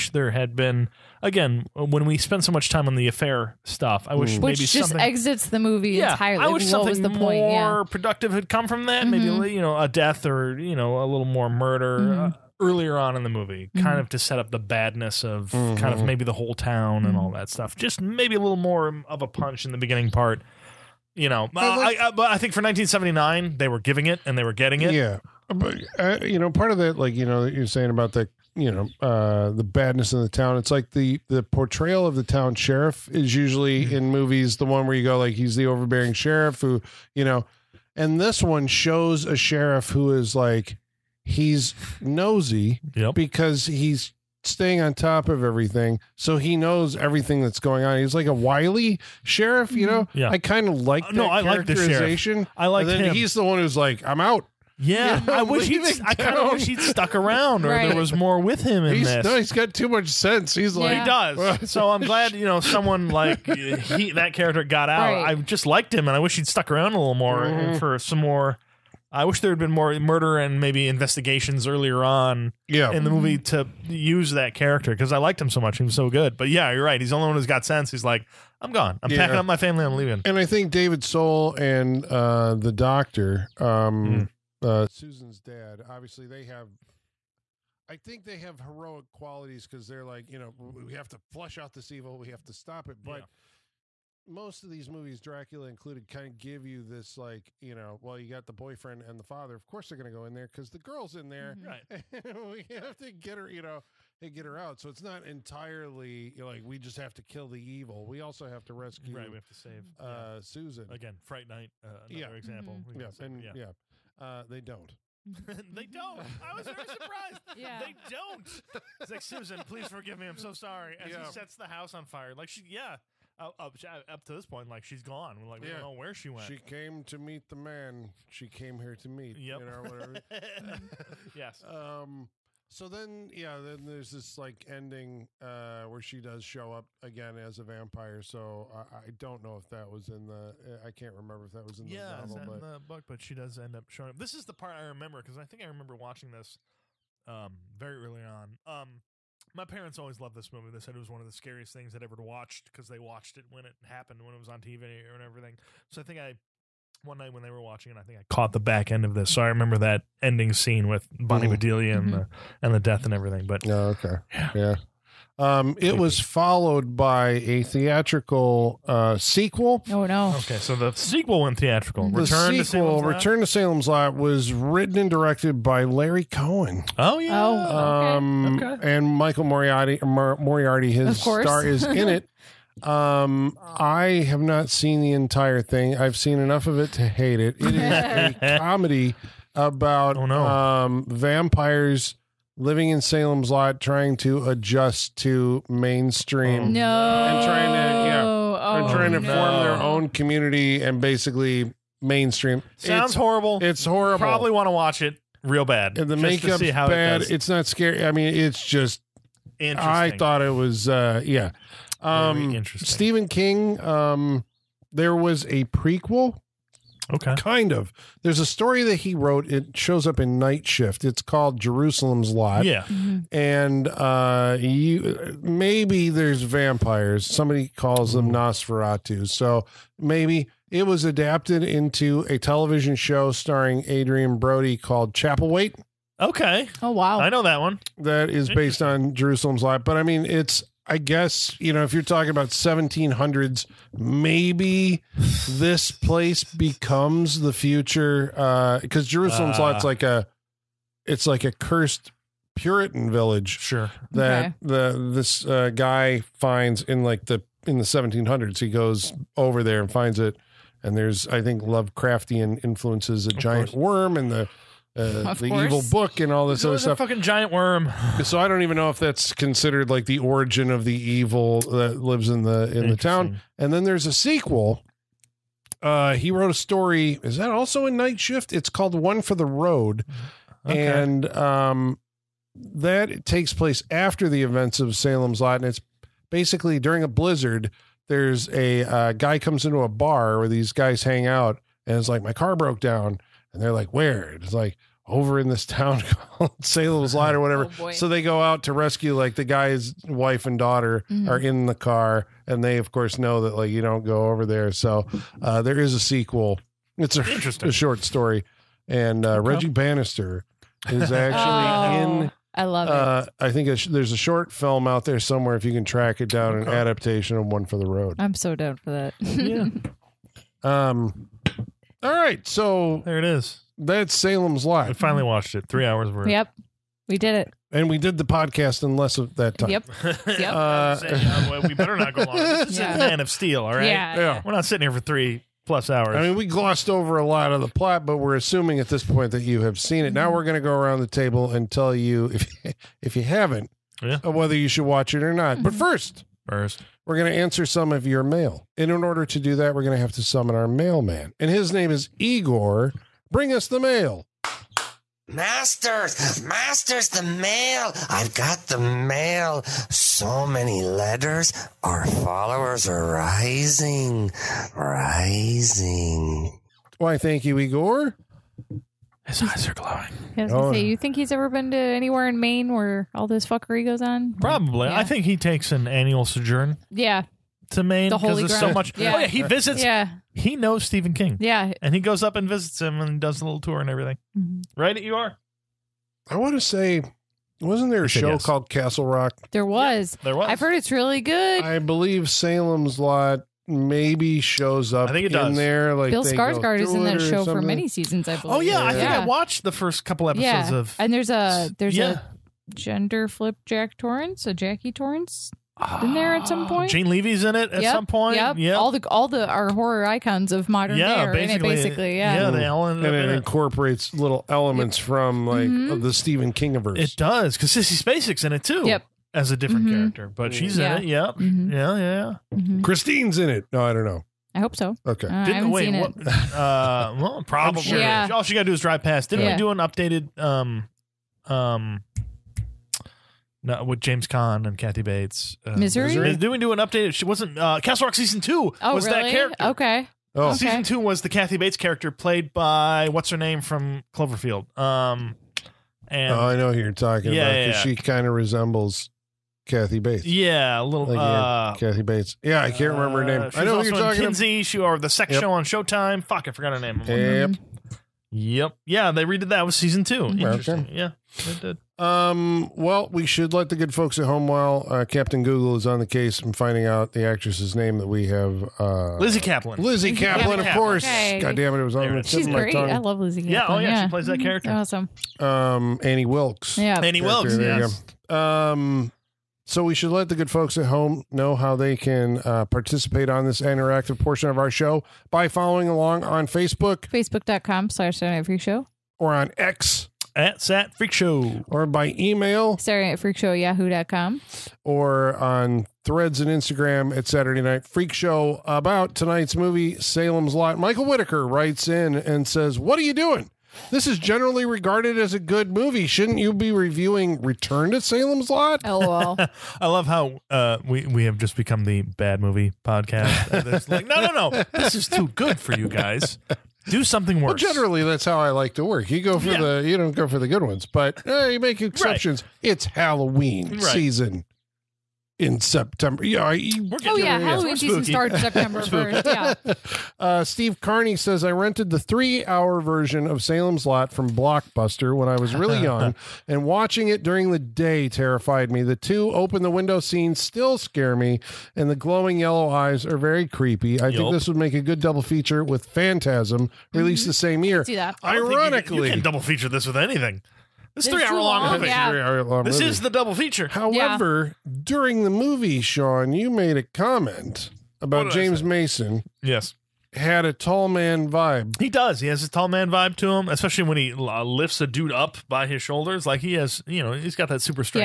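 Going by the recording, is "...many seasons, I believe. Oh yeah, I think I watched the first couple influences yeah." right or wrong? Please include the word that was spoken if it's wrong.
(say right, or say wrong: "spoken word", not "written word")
wrong: "episodes", not "influences".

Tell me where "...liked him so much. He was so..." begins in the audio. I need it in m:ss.
1:15.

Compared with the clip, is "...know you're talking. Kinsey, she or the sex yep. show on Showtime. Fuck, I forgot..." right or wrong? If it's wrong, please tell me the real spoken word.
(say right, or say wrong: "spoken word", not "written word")
right.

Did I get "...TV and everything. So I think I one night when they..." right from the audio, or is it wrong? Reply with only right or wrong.
right.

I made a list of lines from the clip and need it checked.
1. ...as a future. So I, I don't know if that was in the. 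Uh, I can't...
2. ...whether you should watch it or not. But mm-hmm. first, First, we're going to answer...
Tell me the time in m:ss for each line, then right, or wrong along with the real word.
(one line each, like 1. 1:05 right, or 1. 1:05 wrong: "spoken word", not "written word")
1. 2:17 wrong: "vampire", not "future"
2. 5:44 right.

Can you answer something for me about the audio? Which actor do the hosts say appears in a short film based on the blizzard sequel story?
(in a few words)
Reggie Bannister.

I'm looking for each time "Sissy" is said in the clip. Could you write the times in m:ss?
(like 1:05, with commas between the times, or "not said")
6:57.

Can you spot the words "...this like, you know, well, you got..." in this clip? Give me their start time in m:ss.
1:36.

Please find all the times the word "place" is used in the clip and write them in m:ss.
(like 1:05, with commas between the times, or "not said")
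4:05, 4:43.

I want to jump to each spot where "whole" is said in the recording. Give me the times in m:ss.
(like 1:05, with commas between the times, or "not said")
0:16.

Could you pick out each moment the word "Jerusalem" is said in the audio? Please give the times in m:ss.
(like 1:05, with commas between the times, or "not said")
3:41, 3:59, 4:09.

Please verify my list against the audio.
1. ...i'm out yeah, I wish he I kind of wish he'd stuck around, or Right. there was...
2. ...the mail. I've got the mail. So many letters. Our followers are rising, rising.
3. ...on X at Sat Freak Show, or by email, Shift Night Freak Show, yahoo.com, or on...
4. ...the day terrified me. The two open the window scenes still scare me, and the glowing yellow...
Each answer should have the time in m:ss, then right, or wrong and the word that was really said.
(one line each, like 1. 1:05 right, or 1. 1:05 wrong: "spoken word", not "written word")
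1. 0:54 right
2. 5:57 right
3. 8:09 wrong: "Saturday", not "Shift"
4. 8:57 right.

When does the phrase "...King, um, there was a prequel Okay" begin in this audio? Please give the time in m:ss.
3:33.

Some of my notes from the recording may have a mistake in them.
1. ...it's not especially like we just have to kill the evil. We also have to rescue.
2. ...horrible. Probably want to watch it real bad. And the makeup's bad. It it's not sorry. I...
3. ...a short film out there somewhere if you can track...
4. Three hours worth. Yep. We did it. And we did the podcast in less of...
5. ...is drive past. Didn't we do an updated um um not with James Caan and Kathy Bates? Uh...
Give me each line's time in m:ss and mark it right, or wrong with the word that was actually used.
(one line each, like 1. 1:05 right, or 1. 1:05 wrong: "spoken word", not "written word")
1. 1:44 wrong: "entirely", not "especially"
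2. 3:23 wrong: "scary", not "sorry"
3. 5:14 right
4. 5:25 right
5. 7:08 right.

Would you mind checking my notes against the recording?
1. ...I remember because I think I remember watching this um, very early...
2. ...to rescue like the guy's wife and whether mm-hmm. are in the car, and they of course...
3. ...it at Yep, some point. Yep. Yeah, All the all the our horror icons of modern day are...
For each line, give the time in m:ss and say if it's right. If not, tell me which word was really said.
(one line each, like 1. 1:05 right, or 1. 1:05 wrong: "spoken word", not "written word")
1. 2:24 right
2. 4:58 wrong: "daughter", not "whether"
3. 6:47 right.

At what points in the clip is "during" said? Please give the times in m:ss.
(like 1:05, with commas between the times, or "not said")
4:46, 8:57, 9:14.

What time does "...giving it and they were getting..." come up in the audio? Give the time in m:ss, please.
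0:23.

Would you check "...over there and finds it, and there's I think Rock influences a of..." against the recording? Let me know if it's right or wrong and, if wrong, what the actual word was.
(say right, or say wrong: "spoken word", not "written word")
wrong: "Lovecraftian", not "Rock".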